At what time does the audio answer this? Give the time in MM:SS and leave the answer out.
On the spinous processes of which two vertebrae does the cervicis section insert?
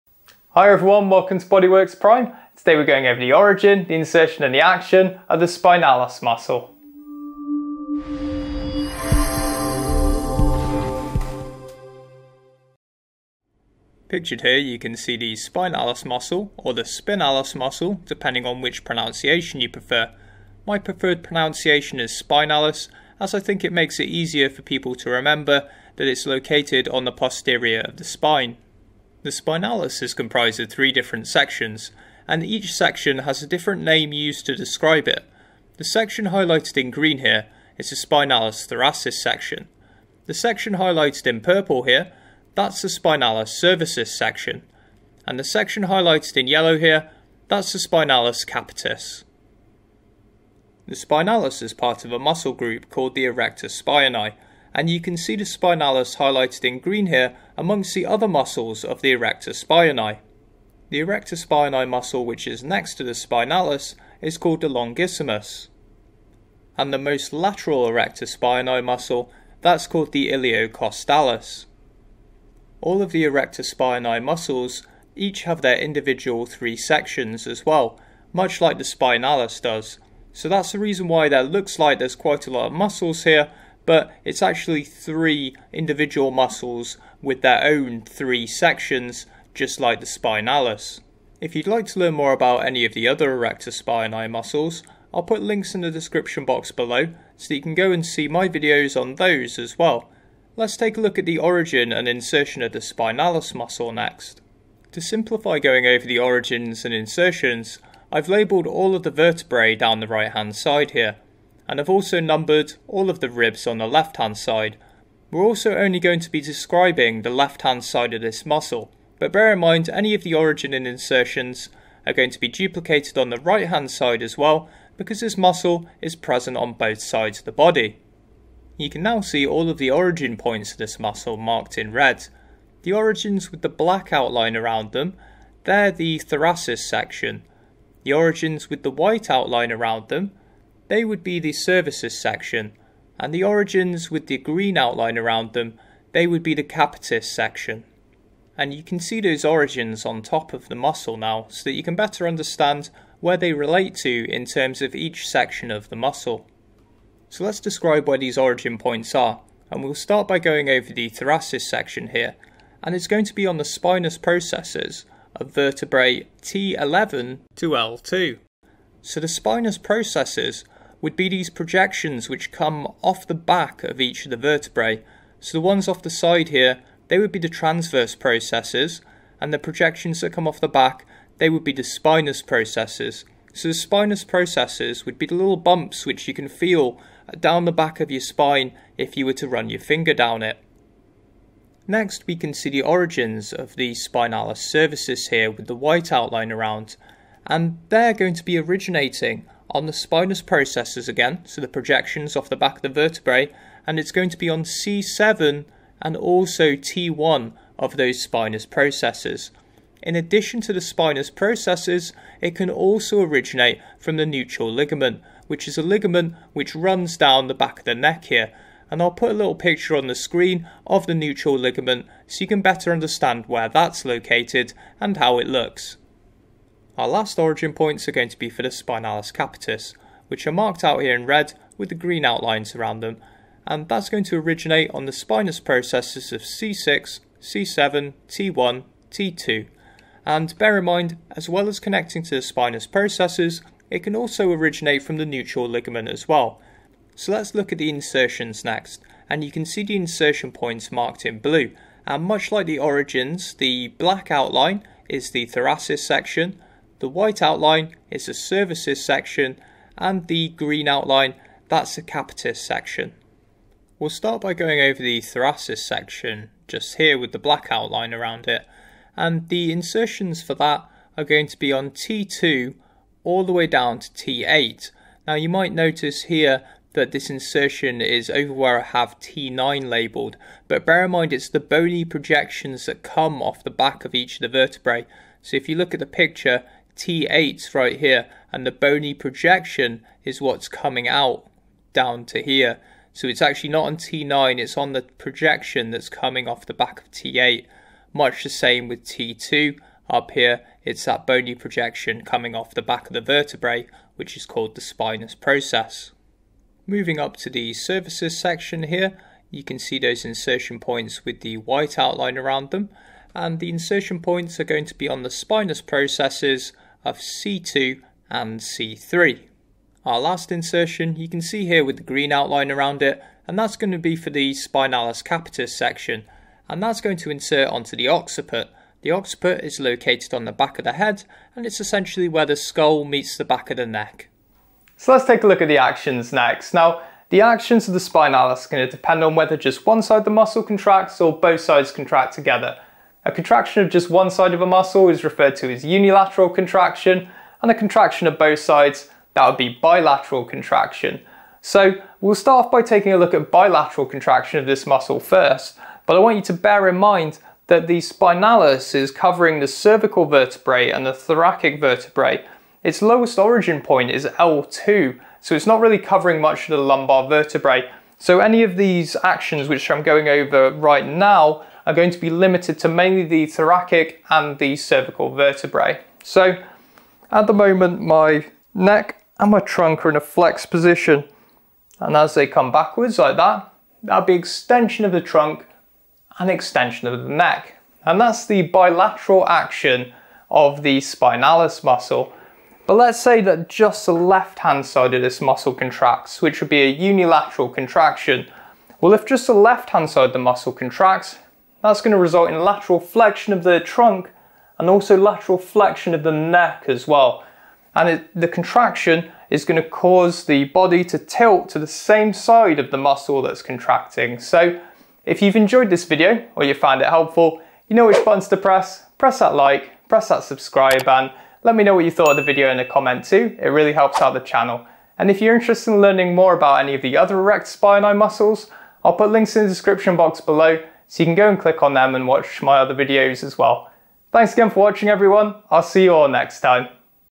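05:17.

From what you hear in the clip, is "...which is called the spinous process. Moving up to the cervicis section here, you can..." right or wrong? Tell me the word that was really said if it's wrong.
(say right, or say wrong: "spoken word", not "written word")
right.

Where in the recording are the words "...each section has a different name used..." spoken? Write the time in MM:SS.
00:32.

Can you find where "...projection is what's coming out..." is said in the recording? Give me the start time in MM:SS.
04:49.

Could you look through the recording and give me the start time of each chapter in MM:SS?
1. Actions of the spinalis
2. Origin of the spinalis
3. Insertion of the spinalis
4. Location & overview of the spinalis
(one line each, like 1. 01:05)
1. 05:35
2. 02:08
3. 04:07
4. 00:14.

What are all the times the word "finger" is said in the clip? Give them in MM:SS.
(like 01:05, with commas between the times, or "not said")
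03:09.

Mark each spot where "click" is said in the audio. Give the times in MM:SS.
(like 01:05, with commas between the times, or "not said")
07:11.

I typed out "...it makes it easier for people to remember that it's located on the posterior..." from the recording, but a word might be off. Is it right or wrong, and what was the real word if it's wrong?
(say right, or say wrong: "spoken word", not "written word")
right.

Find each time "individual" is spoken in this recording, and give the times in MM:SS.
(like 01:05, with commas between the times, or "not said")
01:15, 01:25.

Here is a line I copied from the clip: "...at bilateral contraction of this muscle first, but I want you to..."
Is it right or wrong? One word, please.
right.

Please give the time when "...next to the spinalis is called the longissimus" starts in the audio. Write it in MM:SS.
01:02.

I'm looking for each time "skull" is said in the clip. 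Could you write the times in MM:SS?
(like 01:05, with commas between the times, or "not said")
05:32.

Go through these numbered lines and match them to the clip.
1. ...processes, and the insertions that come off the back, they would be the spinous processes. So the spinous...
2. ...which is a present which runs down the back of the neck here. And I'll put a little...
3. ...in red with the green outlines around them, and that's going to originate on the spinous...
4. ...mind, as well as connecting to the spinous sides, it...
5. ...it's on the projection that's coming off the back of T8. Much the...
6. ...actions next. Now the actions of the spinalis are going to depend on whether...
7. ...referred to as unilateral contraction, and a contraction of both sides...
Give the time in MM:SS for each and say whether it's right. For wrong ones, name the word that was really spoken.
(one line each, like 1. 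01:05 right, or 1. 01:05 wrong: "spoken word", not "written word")
1. 02:58 wrong: "projections", not "insertions"
2. 03:35 wrong: "ligament", not "present"
3. 03:51 right
4. 04:00 wrong: "processes", not "sides"
5. 04:54 right
6. 05:35 right
7. 05:45 right.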